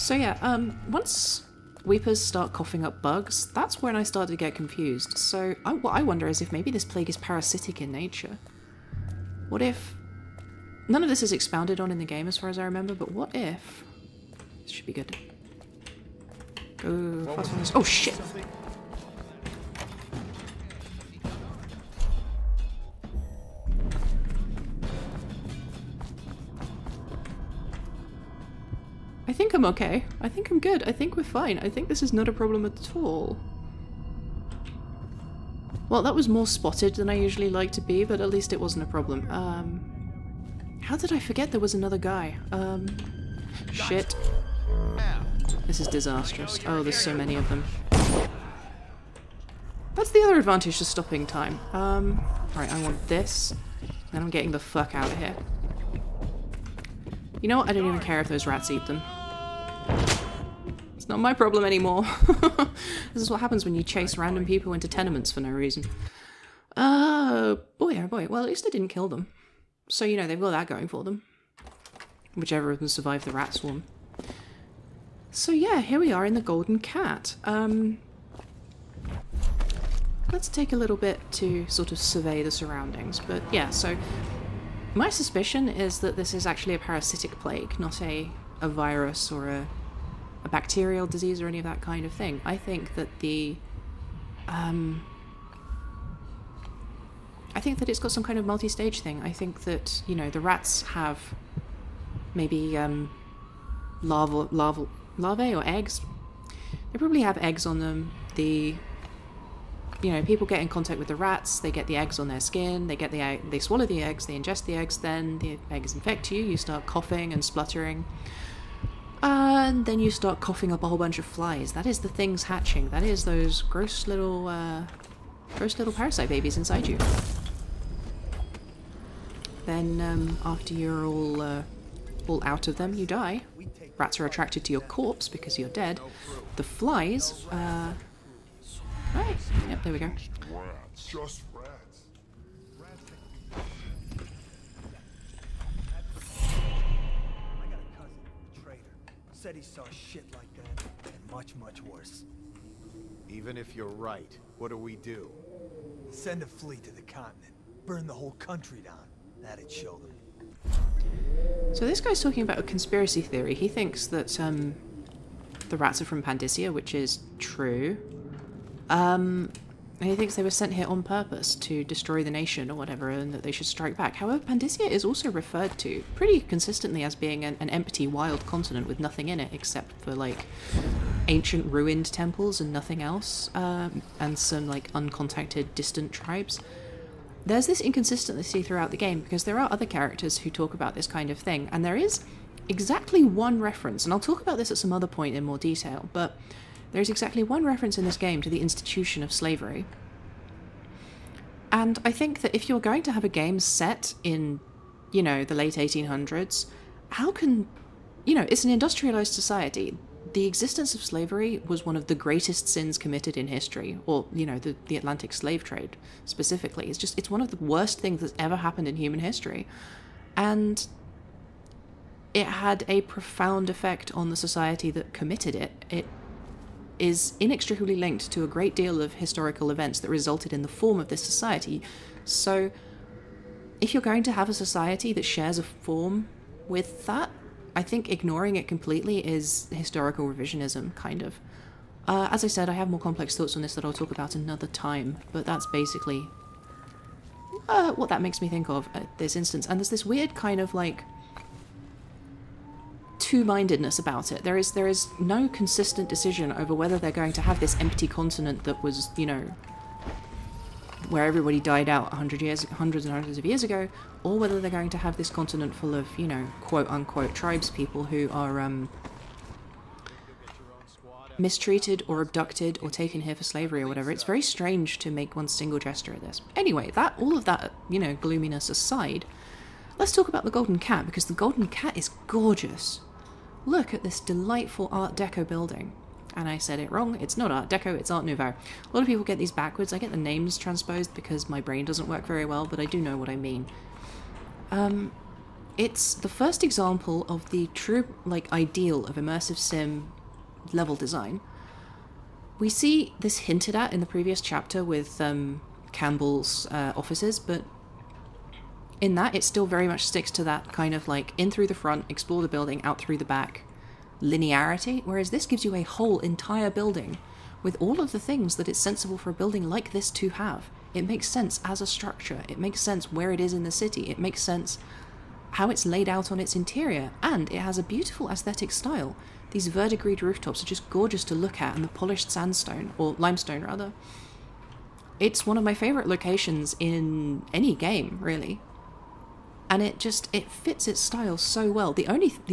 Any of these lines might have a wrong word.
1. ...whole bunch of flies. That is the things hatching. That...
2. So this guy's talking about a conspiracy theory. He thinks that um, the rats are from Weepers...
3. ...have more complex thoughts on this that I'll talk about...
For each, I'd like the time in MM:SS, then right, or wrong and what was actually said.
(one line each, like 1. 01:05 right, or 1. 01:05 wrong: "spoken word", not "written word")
1. 02:00 right
2. 02:41 wrong: "Pandyssia", not "Weepers"
3. 04:02 right.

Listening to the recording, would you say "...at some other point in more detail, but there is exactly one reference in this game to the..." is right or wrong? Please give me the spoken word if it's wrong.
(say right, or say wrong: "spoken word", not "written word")
right.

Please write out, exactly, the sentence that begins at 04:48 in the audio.
A lot of people get these backwards.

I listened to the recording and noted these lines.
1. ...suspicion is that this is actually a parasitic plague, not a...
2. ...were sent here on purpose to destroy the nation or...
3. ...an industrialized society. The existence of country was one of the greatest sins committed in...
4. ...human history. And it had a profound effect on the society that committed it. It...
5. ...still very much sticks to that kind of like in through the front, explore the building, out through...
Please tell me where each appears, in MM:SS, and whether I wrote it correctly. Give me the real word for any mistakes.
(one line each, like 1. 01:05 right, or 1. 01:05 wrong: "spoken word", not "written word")
1. 01:25 right
2. 02:50 right
3. 03:28 wrong: "slavery", not "country"
4. 03:38 right
5. 05:09 right.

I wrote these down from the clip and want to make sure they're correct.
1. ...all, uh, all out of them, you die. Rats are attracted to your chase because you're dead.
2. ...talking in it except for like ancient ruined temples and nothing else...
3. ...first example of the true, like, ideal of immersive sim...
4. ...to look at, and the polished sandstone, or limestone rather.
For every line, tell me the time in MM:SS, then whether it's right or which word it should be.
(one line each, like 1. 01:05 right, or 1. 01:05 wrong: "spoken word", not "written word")
1. 02:11 wrong: "corpse", not "chase"
2. 02:58 wrong: "nothing", not "talking"
3. 04:56 right
4. 05:31 right.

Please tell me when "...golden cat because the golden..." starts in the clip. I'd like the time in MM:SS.
04:40.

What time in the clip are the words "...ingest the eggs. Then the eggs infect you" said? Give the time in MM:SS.
01:54.